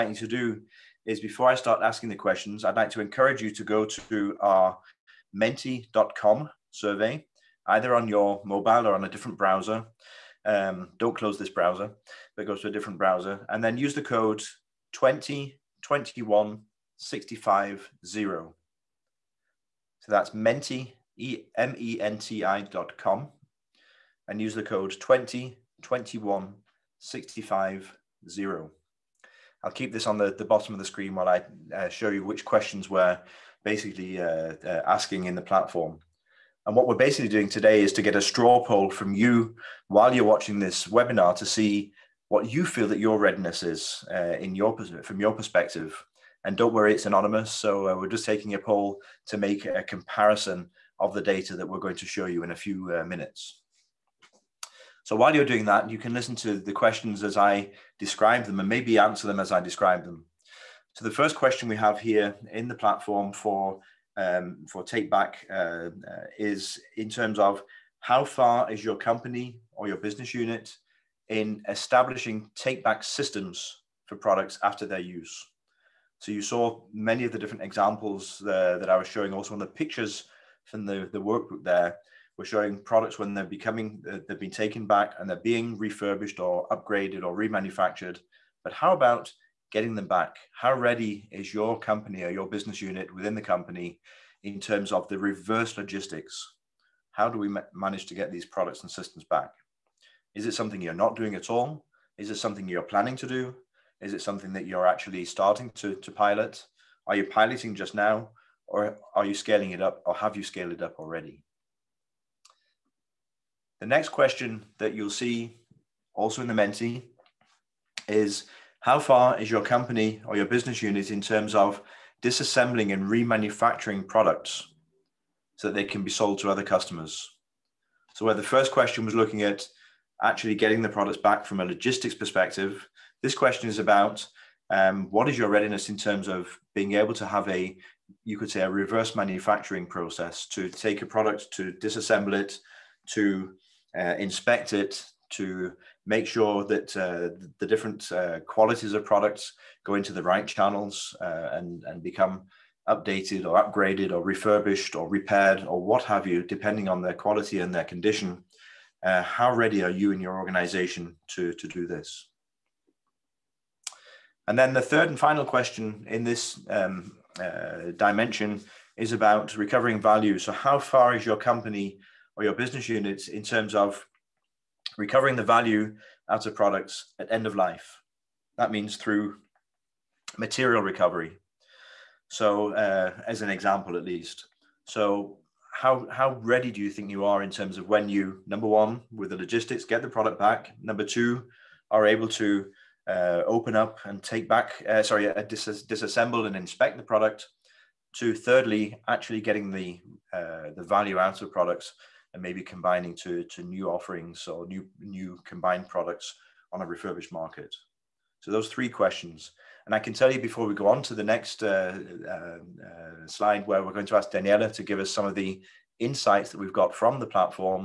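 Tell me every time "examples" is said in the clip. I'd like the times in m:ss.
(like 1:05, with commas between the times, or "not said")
1:17, 3:03.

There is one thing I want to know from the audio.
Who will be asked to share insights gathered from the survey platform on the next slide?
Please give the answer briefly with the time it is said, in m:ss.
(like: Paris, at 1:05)
Daniela, at 3:34.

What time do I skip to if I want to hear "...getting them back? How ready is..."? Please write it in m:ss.
1:29.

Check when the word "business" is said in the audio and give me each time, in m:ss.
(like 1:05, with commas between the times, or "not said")
1:09, 1:32, 2:00, 2:52.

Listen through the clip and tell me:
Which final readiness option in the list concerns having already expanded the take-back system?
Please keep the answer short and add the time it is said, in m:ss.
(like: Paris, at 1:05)
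scaled it up already, at 1:50.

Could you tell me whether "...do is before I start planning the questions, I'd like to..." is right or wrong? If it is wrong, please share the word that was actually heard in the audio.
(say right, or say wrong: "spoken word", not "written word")
wrong: "asking", not "planning".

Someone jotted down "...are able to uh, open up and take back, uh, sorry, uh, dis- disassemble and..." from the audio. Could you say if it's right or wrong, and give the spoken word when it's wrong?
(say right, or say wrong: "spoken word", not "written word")
right.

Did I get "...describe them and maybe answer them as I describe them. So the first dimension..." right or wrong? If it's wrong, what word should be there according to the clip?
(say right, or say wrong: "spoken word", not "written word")
wrong: "question", not "dimension".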